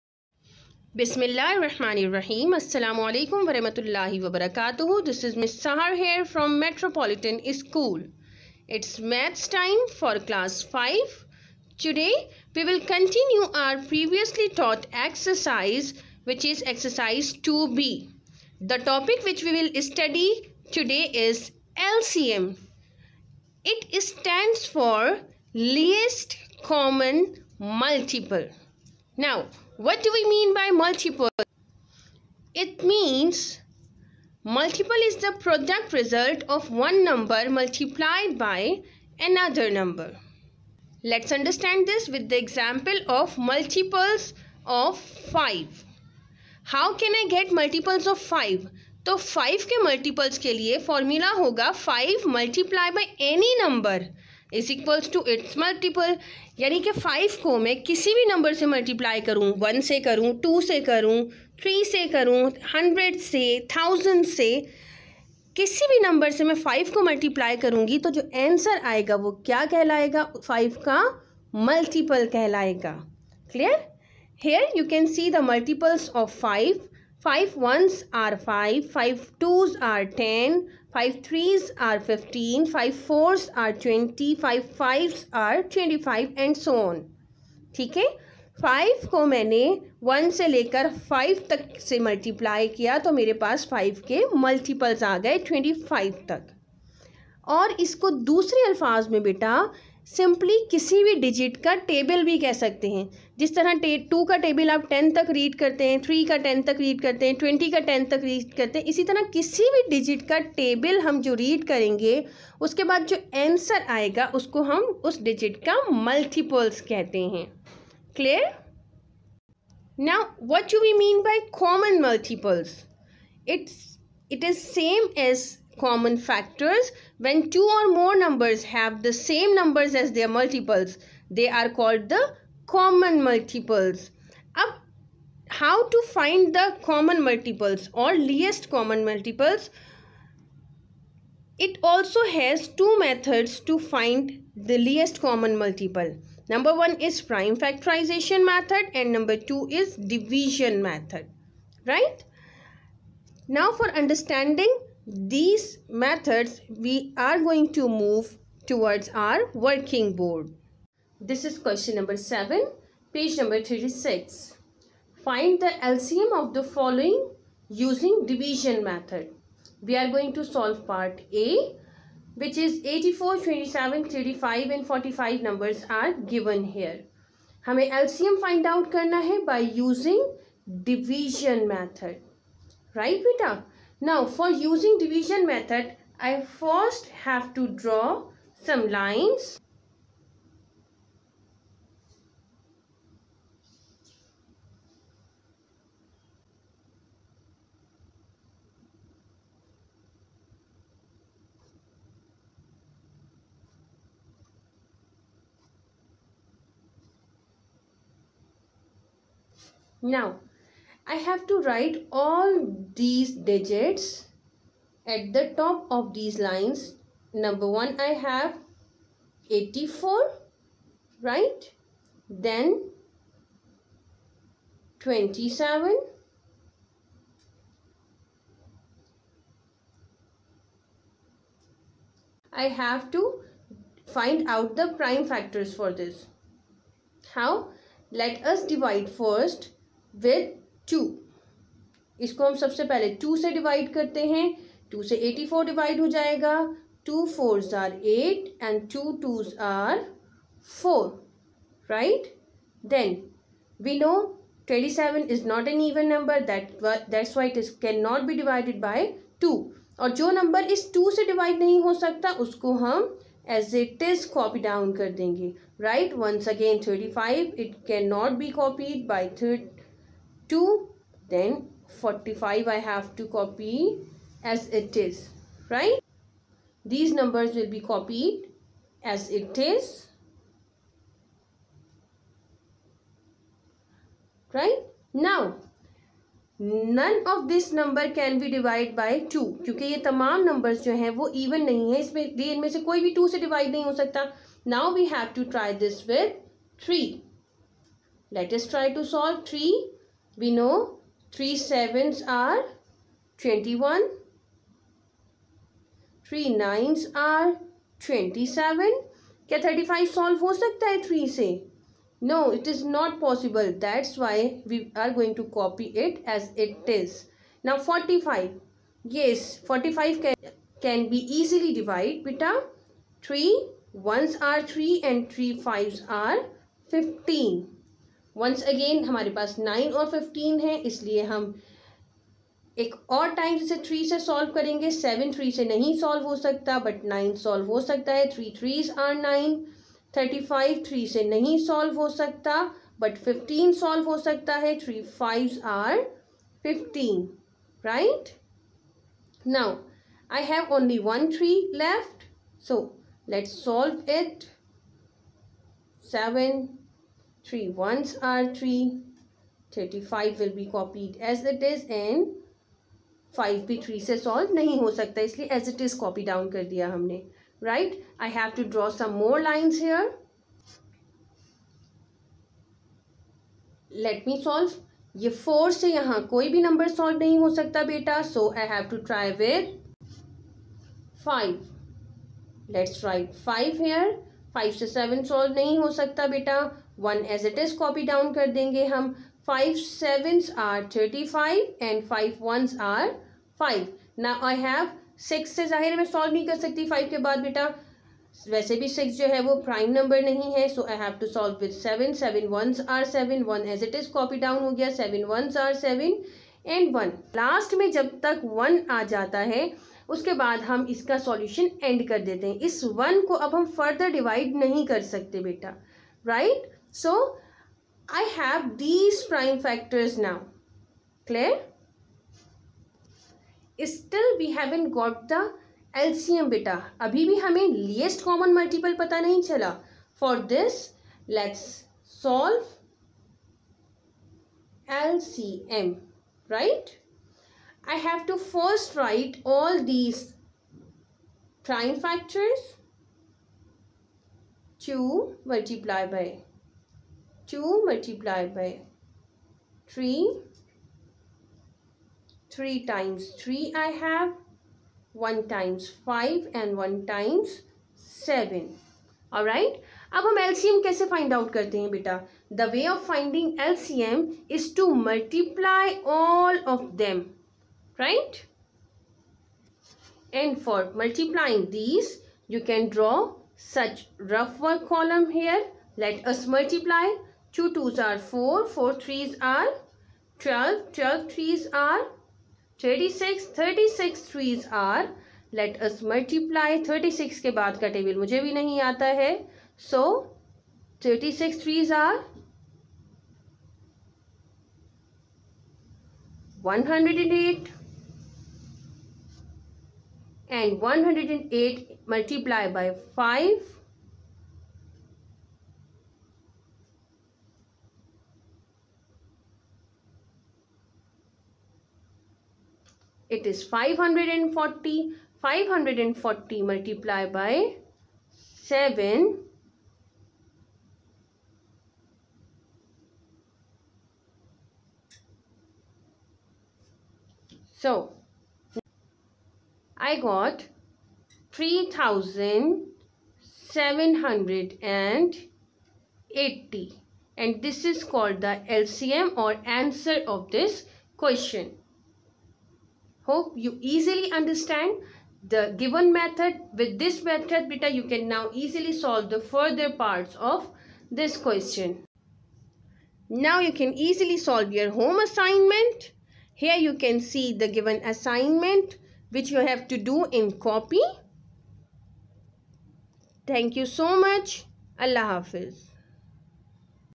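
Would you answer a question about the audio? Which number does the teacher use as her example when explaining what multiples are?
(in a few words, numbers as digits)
5.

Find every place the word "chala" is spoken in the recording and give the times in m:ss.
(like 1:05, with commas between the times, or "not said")
7:09.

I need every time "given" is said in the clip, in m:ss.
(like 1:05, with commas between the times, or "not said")
2:56, 9:05, 9:17.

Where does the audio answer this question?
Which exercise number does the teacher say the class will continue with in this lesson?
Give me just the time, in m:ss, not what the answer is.
0:16.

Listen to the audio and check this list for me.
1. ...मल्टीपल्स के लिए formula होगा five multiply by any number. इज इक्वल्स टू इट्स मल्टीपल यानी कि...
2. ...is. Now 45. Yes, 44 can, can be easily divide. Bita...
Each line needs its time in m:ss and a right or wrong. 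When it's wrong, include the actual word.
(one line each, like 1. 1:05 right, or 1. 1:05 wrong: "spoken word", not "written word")
1. 0:49 right
2. 5:16 wrong: "45", not "44".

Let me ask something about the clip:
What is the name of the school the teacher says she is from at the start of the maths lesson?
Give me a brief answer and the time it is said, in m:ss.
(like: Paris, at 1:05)
Metropolitan School, at 0:06.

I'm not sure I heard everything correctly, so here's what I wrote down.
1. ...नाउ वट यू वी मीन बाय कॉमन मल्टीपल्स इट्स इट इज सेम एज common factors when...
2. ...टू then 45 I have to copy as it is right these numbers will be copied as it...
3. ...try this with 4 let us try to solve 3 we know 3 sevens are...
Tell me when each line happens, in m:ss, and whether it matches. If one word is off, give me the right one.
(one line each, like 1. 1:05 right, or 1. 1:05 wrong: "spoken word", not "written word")
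1. 2:00 right
2. 4:30 right
3. 4:55 wrong: "3", not "4".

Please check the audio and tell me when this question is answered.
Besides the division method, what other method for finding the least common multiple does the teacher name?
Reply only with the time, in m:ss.
2:27.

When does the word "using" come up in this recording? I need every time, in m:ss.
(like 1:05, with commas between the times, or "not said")
2:47, 2:59, 3:04.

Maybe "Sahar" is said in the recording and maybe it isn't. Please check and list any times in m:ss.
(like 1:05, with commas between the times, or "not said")
0:05.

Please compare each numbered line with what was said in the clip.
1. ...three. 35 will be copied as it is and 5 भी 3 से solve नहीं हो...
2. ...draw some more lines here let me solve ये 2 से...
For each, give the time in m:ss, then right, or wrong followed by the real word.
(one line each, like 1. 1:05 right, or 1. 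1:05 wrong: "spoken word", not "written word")
1. 5:58 right
2. 6:08 wrong: "4", not "2".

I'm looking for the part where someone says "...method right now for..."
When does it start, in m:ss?
2:30.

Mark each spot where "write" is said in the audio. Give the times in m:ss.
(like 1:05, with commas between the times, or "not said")
3:31, 6:23, 7:18.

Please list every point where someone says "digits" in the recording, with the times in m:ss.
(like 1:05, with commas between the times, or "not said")
3:33.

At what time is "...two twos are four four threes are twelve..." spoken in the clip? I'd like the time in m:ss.
7:57.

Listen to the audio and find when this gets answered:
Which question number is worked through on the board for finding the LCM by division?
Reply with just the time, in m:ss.
2:41.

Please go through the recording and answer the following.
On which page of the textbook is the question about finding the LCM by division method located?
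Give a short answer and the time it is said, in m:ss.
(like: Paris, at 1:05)
36, at 2:43.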